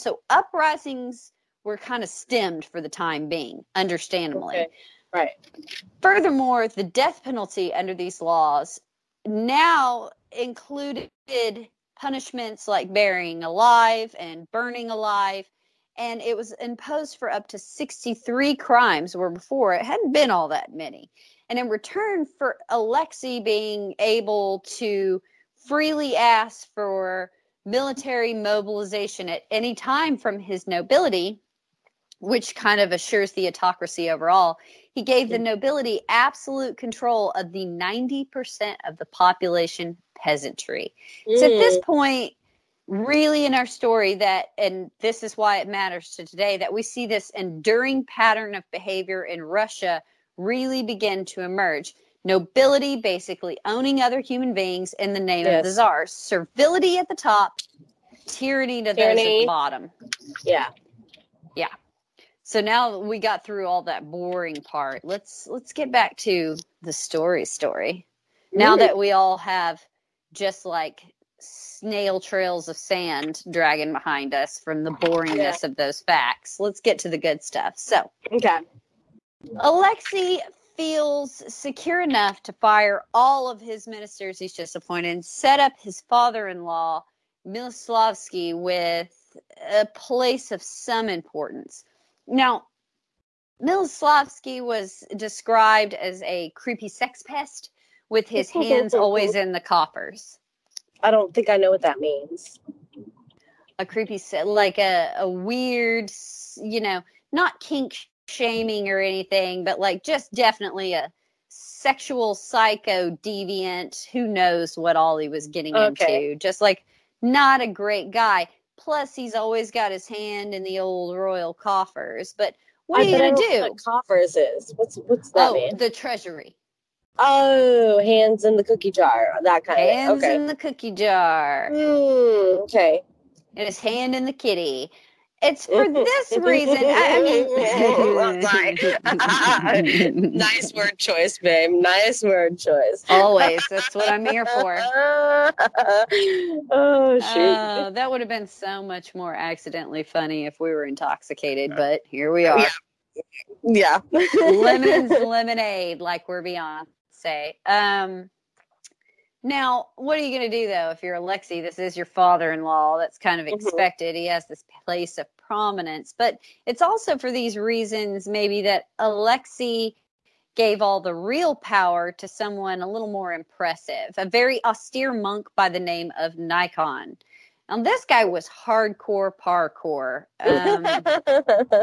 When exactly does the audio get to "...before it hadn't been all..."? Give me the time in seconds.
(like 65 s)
19 s.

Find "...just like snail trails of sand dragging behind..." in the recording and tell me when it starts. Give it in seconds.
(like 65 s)
70 s.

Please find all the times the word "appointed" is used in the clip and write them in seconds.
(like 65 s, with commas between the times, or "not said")
84 s.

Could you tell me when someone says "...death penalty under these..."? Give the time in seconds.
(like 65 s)
6 s.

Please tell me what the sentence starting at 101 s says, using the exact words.
I don't think I know what that means.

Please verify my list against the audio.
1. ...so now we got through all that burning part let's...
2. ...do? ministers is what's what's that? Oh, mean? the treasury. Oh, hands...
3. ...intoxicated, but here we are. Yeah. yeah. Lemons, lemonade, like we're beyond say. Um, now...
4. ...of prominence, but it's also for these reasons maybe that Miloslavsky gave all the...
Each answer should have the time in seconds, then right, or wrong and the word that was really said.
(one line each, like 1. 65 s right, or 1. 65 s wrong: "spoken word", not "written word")
1. 62 s wrong: "boring", not "burning"
2. 123 s wrong: "coffers", not "ministers"
3. 150 s right
4. 165 s wrong: "Alexi", not "Miloslavsky".